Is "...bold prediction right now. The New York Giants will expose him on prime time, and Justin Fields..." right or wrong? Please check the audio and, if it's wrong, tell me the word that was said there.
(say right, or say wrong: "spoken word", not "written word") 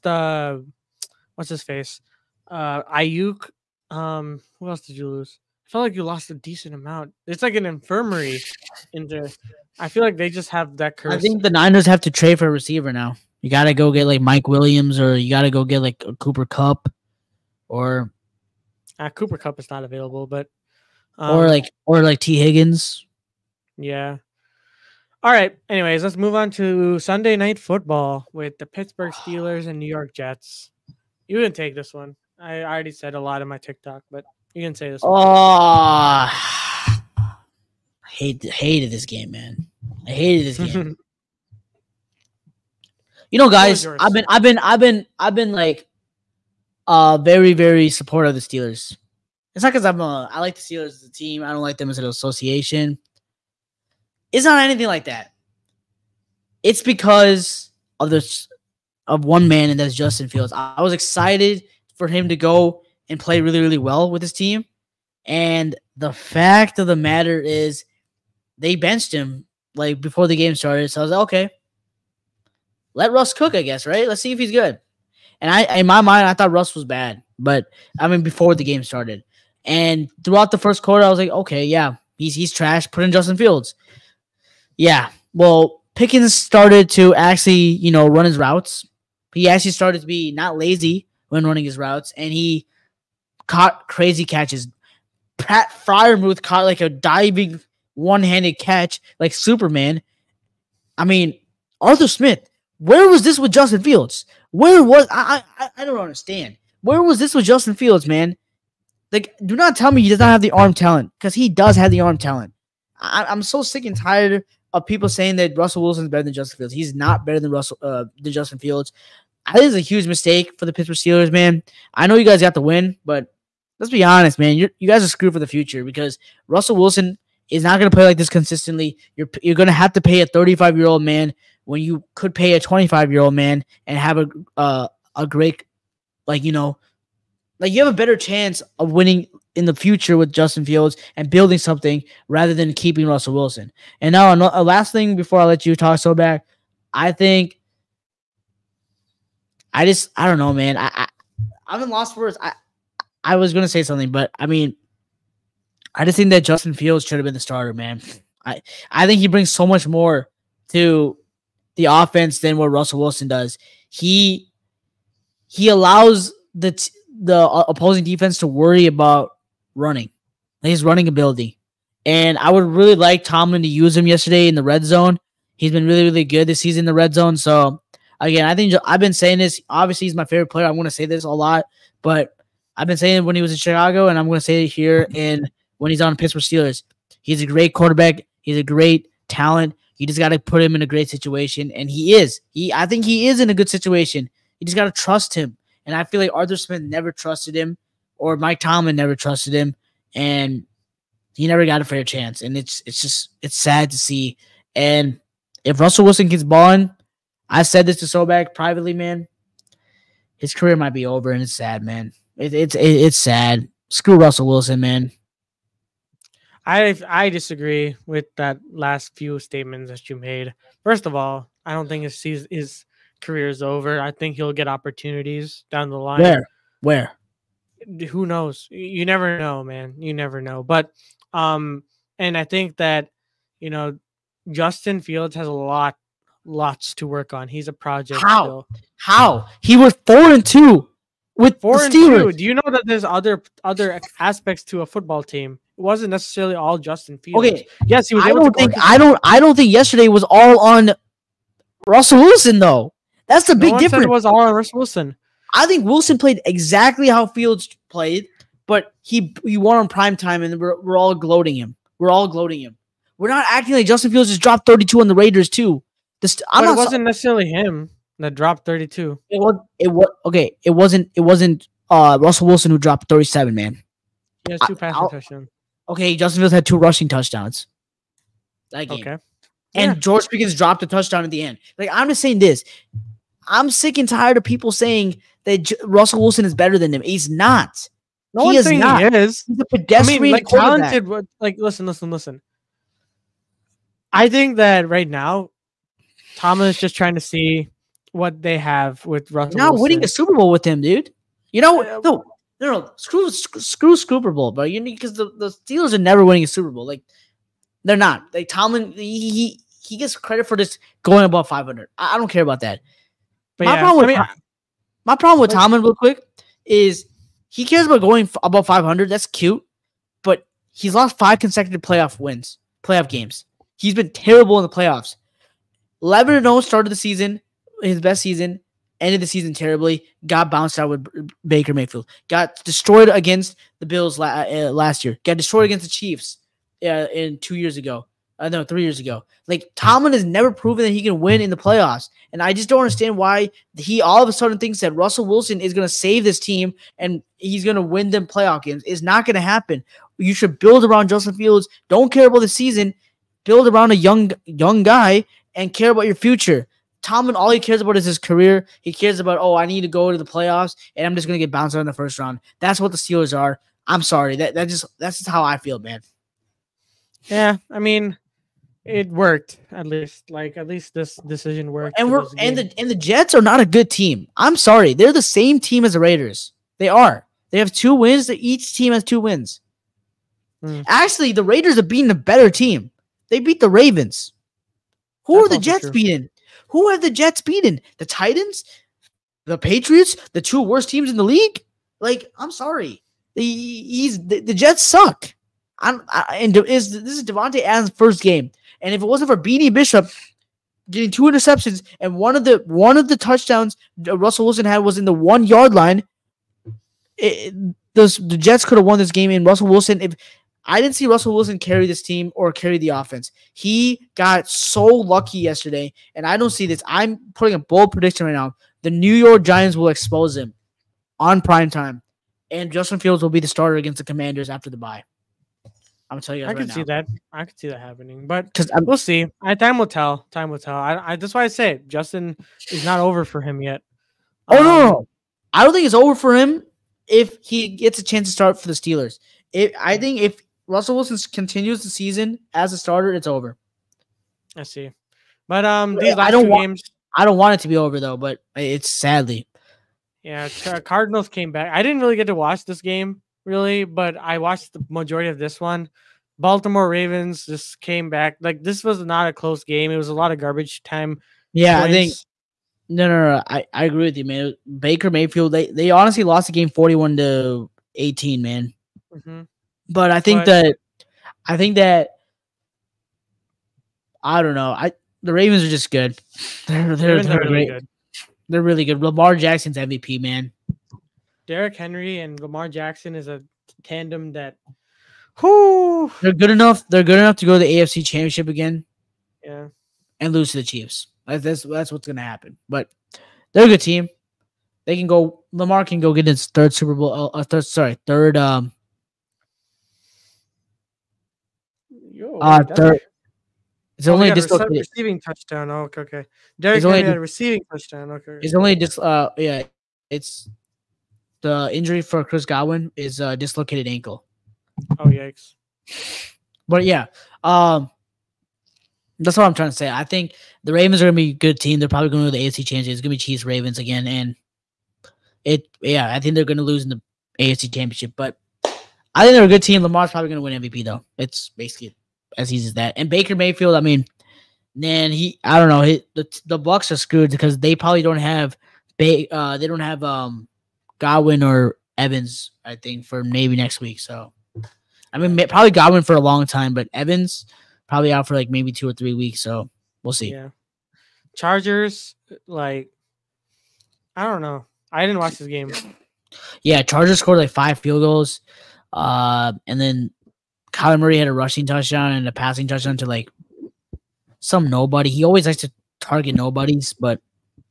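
right.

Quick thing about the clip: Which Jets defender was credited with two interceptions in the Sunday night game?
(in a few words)
Beanie Bishop.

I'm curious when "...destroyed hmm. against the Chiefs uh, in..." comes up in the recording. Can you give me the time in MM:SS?
05:35.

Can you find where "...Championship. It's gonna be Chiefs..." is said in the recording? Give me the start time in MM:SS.
08:42.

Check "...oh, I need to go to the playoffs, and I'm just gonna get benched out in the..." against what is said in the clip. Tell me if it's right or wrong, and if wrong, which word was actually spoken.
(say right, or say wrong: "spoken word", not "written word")
wrong: "bounced", not "benched".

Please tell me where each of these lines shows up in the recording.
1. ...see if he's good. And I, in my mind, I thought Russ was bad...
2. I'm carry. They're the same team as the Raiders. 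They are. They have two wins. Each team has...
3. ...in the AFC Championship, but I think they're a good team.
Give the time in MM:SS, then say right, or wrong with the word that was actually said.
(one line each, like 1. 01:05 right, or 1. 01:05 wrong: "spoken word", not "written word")
1. 01:14 right
2. 06:14 wrong: "sorry", not "carry"
3. 08:46 right.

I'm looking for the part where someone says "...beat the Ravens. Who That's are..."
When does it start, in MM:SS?
06:23.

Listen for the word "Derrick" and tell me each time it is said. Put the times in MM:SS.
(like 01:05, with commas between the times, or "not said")
08:01, 08:26.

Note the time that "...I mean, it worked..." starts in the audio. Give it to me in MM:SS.
06:07.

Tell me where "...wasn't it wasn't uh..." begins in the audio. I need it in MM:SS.
04:30.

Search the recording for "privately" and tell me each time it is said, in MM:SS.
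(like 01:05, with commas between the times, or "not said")
03:28.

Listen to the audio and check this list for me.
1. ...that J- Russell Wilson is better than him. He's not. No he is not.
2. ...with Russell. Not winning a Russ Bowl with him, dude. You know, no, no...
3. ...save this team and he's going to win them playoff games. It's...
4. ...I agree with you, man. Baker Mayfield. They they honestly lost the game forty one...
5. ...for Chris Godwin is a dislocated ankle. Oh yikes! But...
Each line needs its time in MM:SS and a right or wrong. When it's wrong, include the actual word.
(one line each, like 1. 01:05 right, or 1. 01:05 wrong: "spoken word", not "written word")
1. 04:45 right
2. 04:59 wrong: "Super", not "Russ"
3. 05:45 right
4. 07:43 right
5. 08:32 right.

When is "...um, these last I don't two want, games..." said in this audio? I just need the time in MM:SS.
07:25.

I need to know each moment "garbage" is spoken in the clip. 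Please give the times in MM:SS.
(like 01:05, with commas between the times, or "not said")
07:40.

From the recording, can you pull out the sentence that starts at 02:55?
He's been really, really good this season in the red zone.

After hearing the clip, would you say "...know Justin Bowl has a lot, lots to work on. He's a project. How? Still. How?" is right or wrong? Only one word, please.
wrong.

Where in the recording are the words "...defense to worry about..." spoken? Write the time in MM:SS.
02:48.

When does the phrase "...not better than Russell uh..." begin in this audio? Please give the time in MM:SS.
01:56.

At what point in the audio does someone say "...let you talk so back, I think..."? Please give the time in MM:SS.
02:25.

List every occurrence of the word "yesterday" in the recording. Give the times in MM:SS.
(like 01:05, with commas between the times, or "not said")
02:54, 04:09, 06:55.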